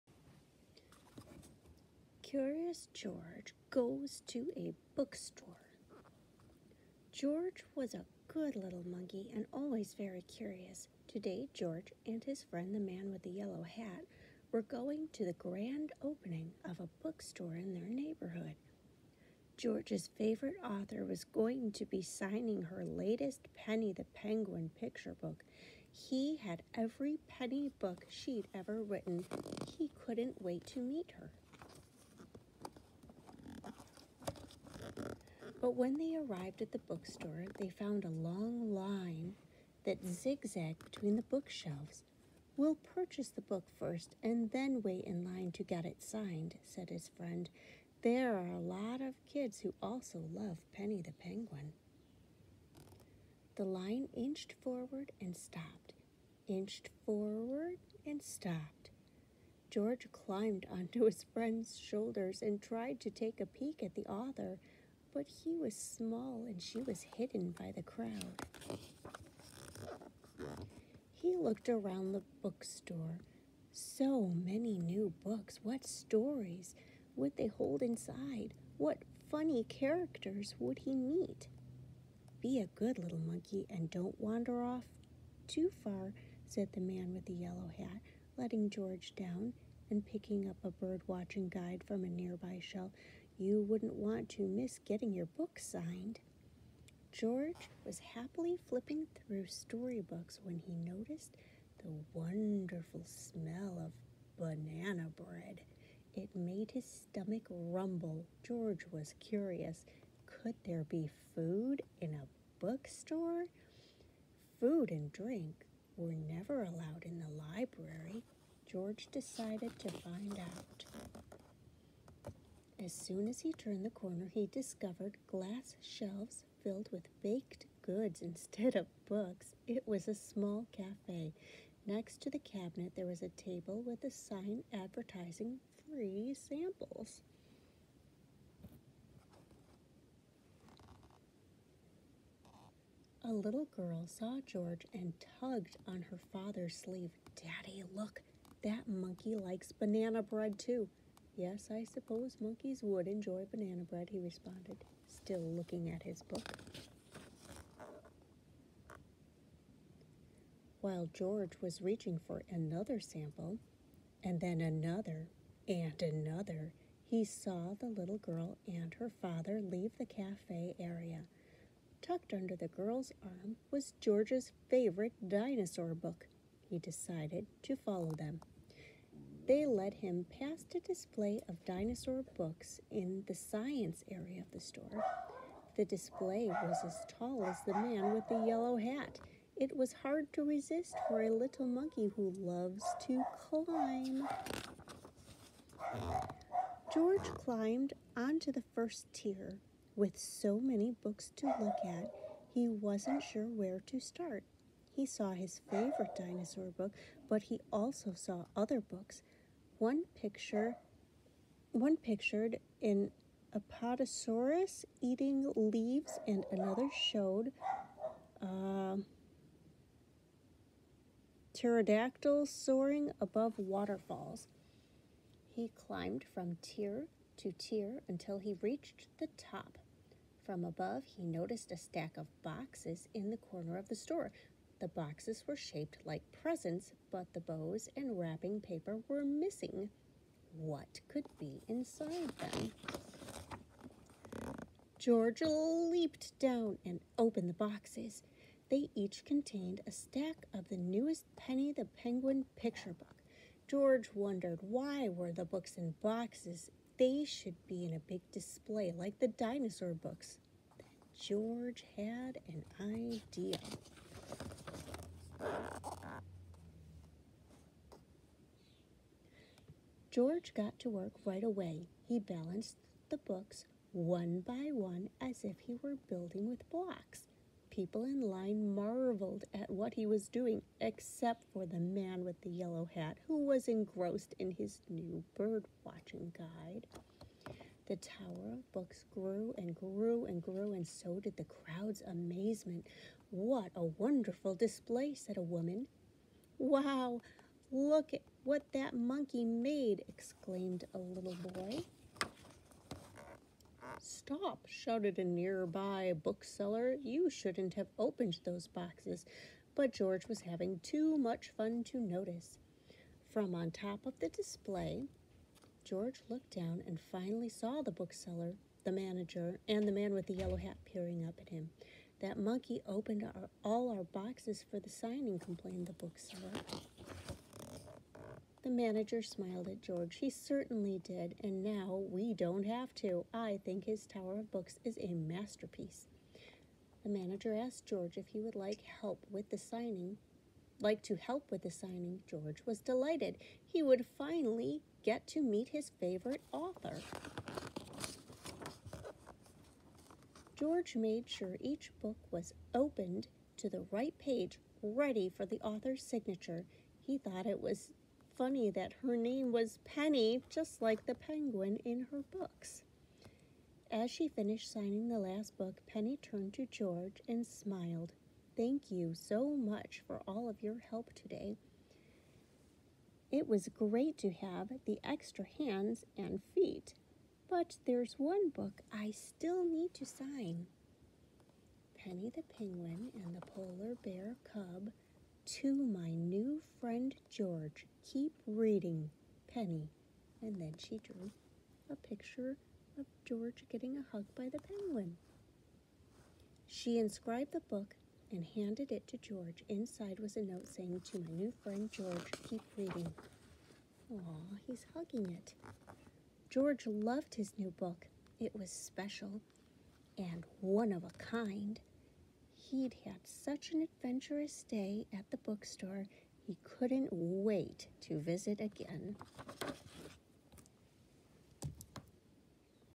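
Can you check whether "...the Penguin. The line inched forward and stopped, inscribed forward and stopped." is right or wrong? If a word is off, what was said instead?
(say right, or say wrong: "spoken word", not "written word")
wrong: "inched", not "inscribed".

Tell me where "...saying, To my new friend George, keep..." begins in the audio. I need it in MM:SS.
06:40.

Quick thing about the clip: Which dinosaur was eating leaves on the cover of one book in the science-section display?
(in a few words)
Apatosaurus.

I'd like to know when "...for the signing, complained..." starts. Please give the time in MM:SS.
05:24.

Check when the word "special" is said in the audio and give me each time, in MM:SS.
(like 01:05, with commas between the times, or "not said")
06:48.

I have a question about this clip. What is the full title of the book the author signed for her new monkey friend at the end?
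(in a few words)
Penny the Penguin and the Polar Bear Cub.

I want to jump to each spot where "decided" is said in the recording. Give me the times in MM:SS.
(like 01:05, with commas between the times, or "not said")
01:59, 02:56.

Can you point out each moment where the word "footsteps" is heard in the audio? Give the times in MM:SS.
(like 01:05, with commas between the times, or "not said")
not said.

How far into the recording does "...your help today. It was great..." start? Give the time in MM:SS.
06:10.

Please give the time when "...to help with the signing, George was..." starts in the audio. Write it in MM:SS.
05:41.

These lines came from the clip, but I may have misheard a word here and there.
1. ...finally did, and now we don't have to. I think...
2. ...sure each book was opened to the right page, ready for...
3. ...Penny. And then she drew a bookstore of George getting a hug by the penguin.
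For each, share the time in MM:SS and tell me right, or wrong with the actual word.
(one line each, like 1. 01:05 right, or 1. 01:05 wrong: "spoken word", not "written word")
1. 05:30 wrong: "certainly", not "finally"
2. 05:51 right
3. 06:29 wrong: "picture", not "bookstore".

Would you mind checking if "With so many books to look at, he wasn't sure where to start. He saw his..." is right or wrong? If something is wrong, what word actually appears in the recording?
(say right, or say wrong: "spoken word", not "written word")
right.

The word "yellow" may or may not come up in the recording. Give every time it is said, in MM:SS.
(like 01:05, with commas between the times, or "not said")
00:13, 01:27, 03:08, 04:42, 05:20.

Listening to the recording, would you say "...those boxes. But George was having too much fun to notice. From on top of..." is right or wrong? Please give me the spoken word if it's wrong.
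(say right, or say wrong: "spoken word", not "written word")
right.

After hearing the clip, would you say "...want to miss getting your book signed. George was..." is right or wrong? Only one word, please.
right.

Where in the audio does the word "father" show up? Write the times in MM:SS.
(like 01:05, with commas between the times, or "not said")
02:26, 02:49.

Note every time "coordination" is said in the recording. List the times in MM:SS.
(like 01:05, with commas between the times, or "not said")
not said.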